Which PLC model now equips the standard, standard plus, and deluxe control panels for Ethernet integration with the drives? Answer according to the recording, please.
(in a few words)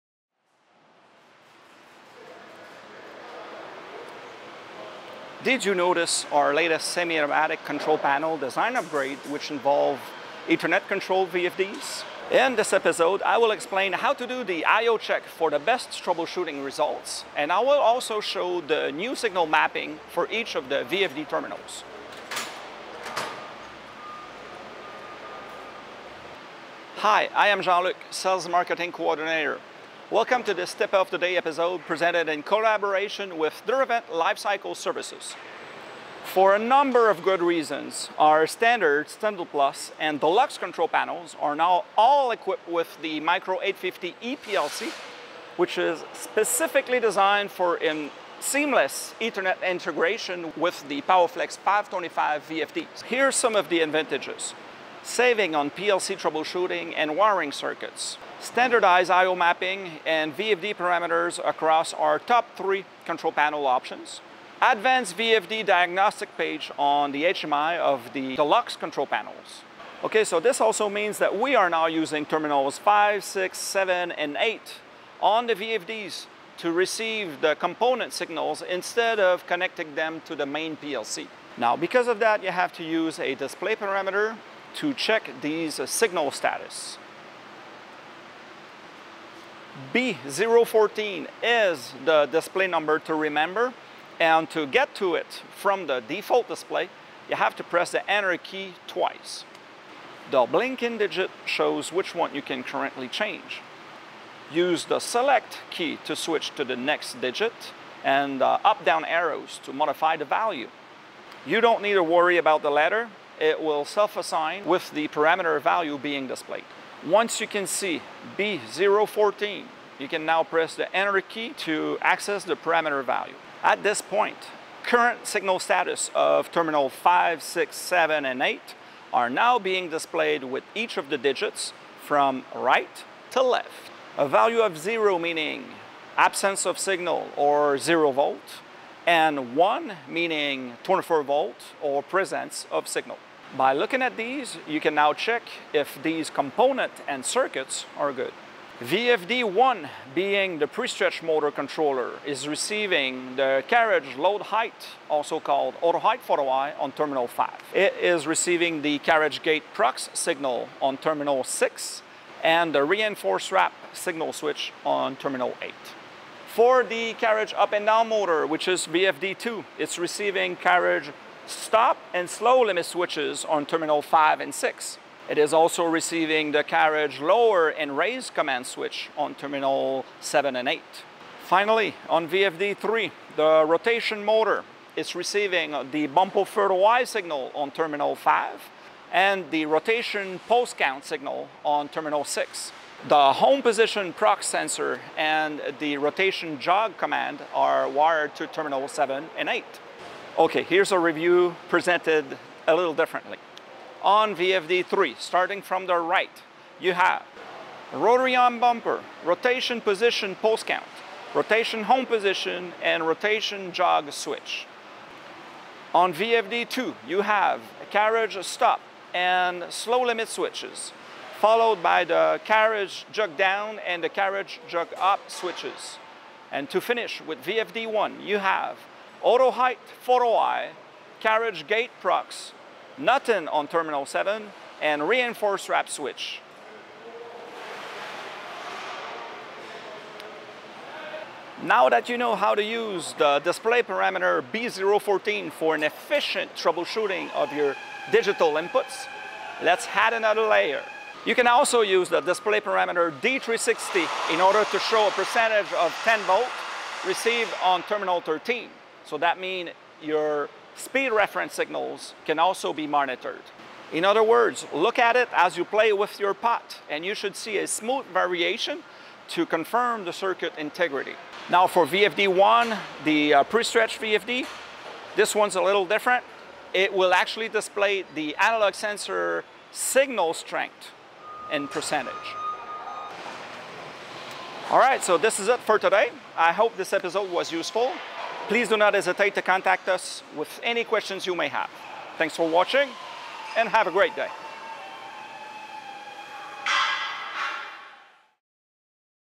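Micro 850.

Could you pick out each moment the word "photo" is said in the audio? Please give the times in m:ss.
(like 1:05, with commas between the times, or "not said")
2:36, 3:50.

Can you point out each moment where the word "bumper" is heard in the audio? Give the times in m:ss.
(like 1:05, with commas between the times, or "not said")
3:06, 3:28.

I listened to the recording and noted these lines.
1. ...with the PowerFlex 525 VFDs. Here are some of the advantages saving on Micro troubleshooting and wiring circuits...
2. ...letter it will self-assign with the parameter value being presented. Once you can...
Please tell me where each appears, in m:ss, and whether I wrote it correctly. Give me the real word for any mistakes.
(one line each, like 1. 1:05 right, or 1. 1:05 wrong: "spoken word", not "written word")
1. 0:50 wrong: "PLC", not "Micro"
2. 1:52 wrong: "displayed", not "presented".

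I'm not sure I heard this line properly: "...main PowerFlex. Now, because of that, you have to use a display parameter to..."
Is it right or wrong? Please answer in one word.
wrong.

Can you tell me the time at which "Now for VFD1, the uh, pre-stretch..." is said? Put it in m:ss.
4:31.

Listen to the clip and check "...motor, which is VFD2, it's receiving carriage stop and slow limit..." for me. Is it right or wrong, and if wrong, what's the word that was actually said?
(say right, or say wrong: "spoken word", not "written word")
right.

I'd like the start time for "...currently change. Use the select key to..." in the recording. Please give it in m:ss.
1:42.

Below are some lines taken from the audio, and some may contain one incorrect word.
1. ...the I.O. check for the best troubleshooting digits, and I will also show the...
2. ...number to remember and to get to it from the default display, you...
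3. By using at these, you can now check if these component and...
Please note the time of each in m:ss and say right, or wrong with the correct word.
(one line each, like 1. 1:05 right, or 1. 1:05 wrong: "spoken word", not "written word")
1. 0:14 wrong: "results", not "digits"
2. 1:32 right
3. 2:23 wrong: "looking", not "using".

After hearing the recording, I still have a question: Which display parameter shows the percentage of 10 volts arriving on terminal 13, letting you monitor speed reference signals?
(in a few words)
D360.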